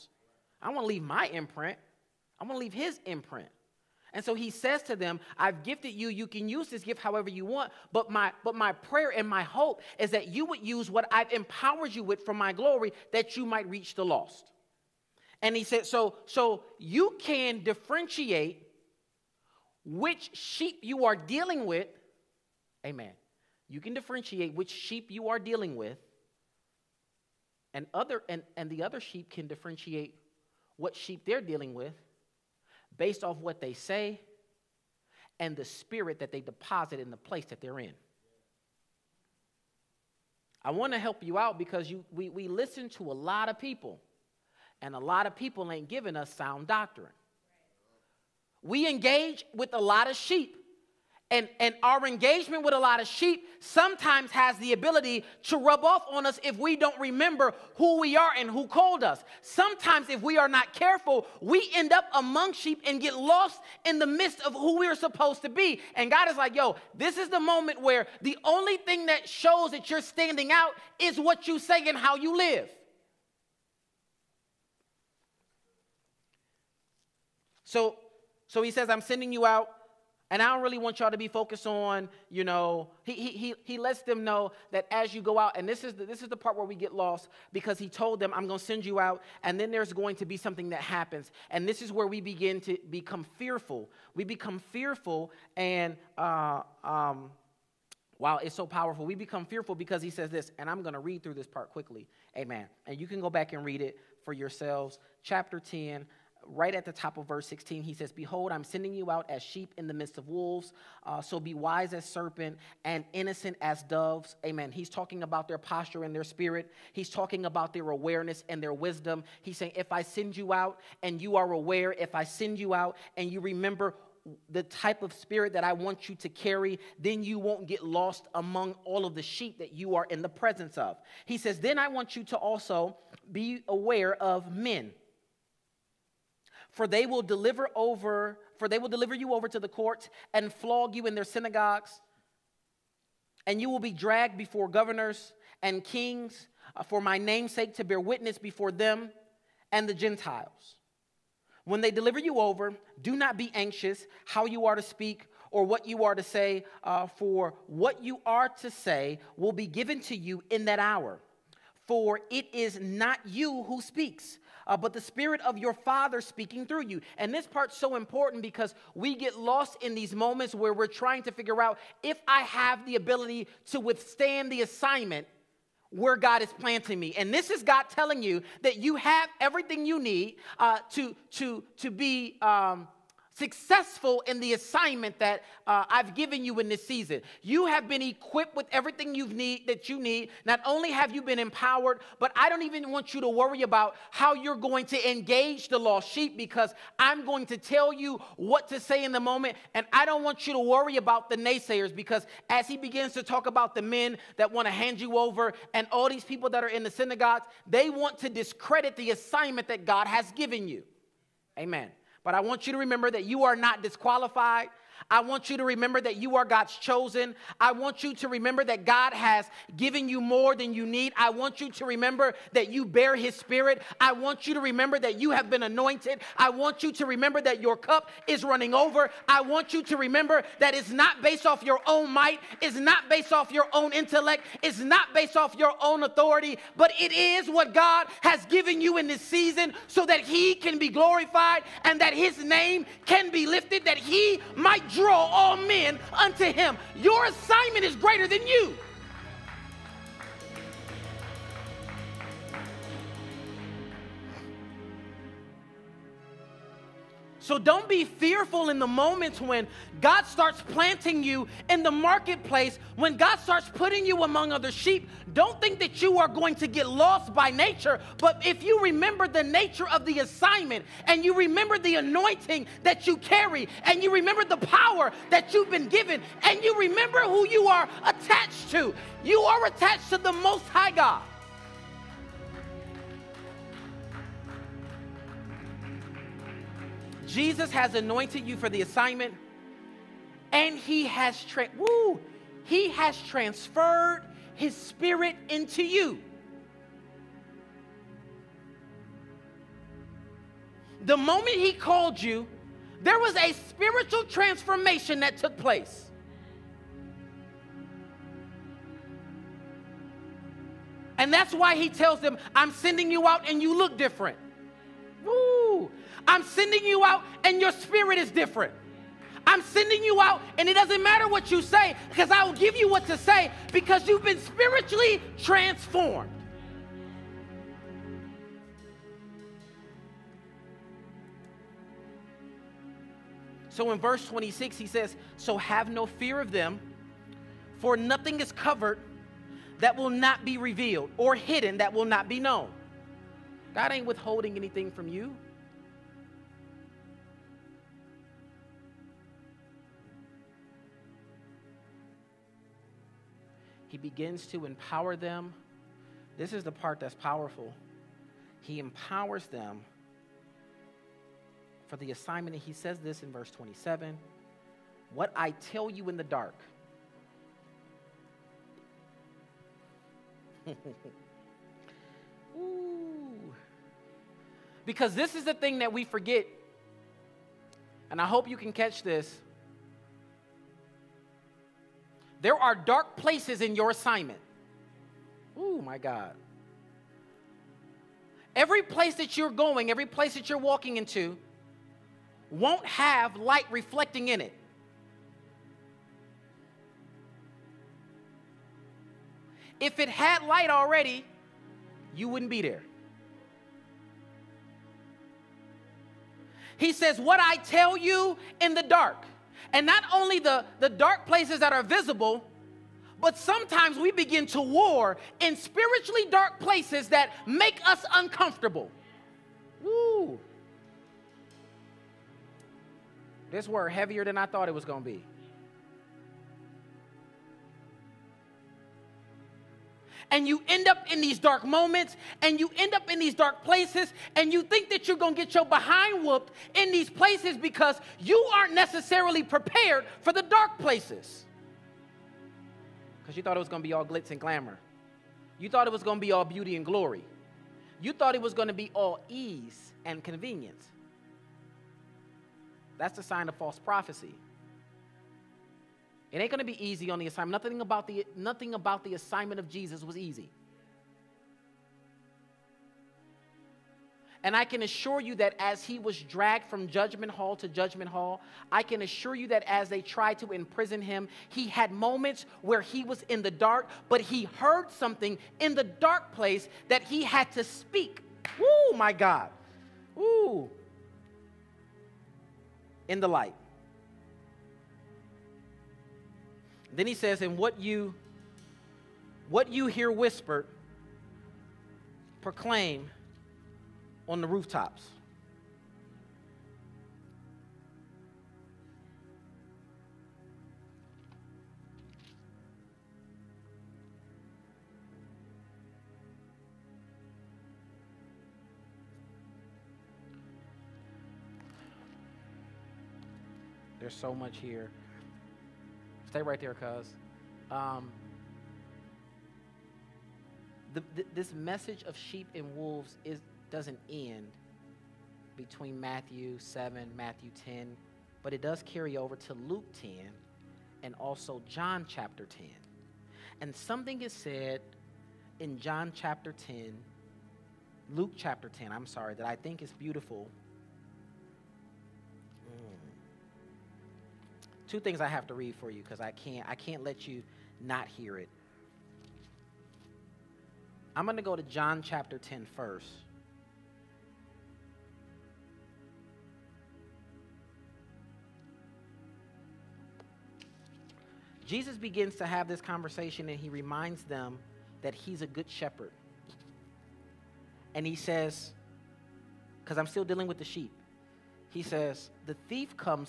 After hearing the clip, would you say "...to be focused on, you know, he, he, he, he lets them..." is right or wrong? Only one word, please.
right.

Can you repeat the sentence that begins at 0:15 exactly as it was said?
And he said, so so you can differentiate which sheep you are dealing with.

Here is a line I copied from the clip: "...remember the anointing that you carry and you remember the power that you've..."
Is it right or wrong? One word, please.
right.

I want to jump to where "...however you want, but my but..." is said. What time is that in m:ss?
0:07.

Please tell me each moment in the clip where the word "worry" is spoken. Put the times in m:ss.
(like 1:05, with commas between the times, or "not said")
3:13, 3:20.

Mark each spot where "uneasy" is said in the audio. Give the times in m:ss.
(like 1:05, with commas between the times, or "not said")
not said.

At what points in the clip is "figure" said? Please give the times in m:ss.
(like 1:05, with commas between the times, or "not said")
2:51.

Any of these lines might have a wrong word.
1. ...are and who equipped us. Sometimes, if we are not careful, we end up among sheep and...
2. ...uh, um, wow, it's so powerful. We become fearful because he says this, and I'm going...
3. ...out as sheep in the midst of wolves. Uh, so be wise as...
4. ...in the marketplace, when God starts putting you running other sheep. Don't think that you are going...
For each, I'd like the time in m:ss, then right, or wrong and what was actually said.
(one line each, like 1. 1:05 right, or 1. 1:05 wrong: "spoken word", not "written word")
1. 0:58 wrong: "called", not "equipped"
2. 1:36 right
3. 1:49 right
4. 4:21 wrong: "among", not "running".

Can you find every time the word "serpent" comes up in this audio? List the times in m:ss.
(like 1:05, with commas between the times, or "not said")
1:52.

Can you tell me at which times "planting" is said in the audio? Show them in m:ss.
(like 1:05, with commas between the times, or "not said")
2:56, 4:20.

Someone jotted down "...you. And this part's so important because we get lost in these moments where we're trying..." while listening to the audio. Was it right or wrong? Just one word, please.
right.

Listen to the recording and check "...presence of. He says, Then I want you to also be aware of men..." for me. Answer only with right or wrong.
right.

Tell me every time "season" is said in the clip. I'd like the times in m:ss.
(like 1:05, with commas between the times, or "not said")
3:06, 3:59.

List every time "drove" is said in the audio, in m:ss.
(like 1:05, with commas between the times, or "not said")
not said.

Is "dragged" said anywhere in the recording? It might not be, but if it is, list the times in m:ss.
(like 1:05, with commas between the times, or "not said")
2:23, 7:46.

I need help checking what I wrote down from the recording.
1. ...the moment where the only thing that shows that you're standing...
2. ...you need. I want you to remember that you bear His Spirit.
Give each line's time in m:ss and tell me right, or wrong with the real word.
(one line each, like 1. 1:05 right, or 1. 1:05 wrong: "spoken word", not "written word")
1. 1:07 right
2. 3:40 right.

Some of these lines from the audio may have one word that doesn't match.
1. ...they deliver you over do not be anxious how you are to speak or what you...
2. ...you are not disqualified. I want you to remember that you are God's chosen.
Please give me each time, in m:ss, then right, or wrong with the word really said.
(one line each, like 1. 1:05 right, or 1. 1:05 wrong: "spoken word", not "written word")
1. 2:31 right
2. 3:33 right.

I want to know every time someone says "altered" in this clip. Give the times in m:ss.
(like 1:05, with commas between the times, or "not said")
not said.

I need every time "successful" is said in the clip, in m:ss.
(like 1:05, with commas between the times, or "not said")
3:03.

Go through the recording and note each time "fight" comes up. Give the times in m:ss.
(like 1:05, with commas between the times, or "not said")
not said.